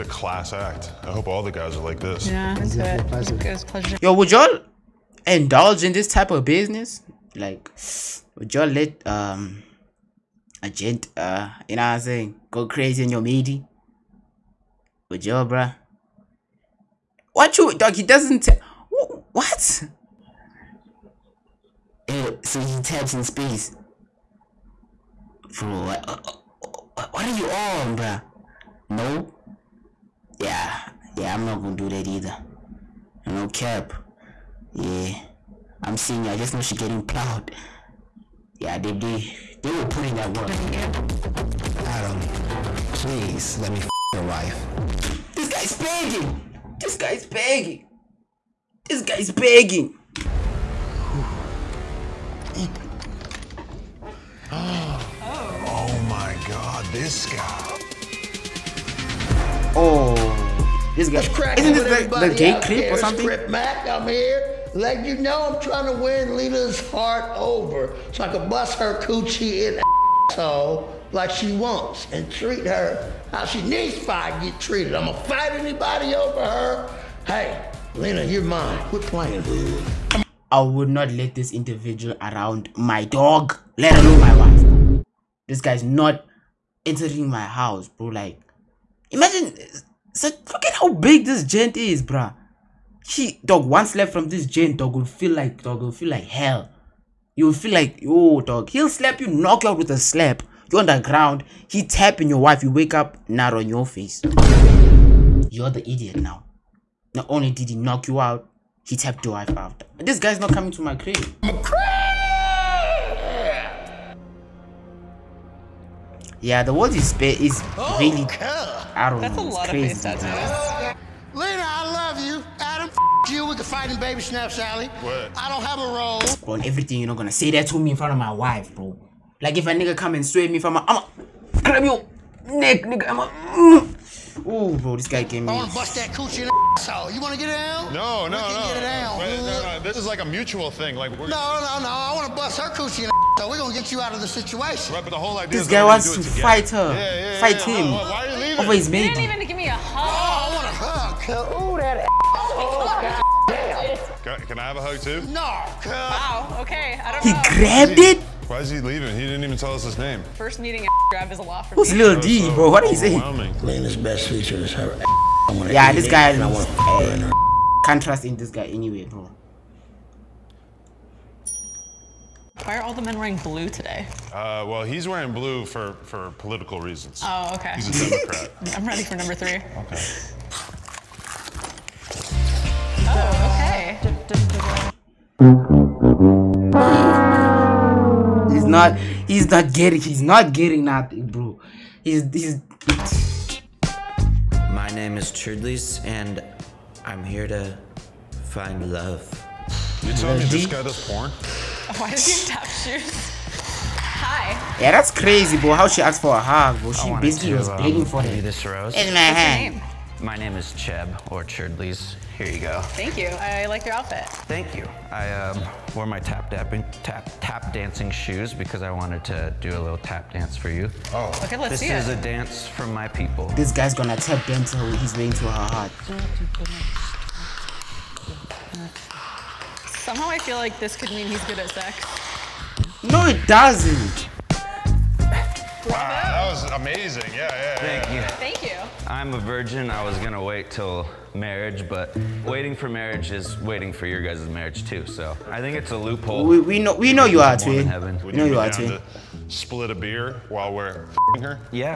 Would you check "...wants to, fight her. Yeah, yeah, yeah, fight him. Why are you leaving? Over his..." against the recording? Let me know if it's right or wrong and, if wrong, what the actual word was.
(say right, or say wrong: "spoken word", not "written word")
right.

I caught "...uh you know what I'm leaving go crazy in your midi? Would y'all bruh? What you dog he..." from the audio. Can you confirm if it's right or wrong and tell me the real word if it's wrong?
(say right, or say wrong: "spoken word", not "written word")
wrong: "saying", not "leaving".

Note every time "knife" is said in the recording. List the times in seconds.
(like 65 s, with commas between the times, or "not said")
not said.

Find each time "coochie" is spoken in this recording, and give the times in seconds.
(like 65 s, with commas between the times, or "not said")
68 s, 136 s, 142 s.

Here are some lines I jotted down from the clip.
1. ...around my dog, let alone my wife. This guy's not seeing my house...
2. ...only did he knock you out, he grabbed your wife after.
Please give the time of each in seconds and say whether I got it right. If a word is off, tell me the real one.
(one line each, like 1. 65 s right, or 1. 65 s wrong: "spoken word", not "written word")
1. 82 s wrong: "entering", not "seeing"
2. 107 s wrong: "tapped", not "grabbed".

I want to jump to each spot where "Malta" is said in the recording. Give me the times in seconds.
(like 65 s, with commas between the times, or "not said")
not said.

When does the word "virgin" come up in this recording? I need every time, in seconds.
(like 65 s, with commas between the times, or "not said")
239 s.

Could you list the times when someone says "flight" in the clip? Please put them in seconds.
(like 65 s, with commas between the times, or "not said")
not said.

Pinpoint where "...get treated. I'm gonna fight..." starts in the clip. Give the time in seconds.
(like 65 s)
74 s.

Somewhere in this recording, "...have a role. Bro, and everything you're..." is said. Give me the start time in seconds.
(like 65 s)
125 s.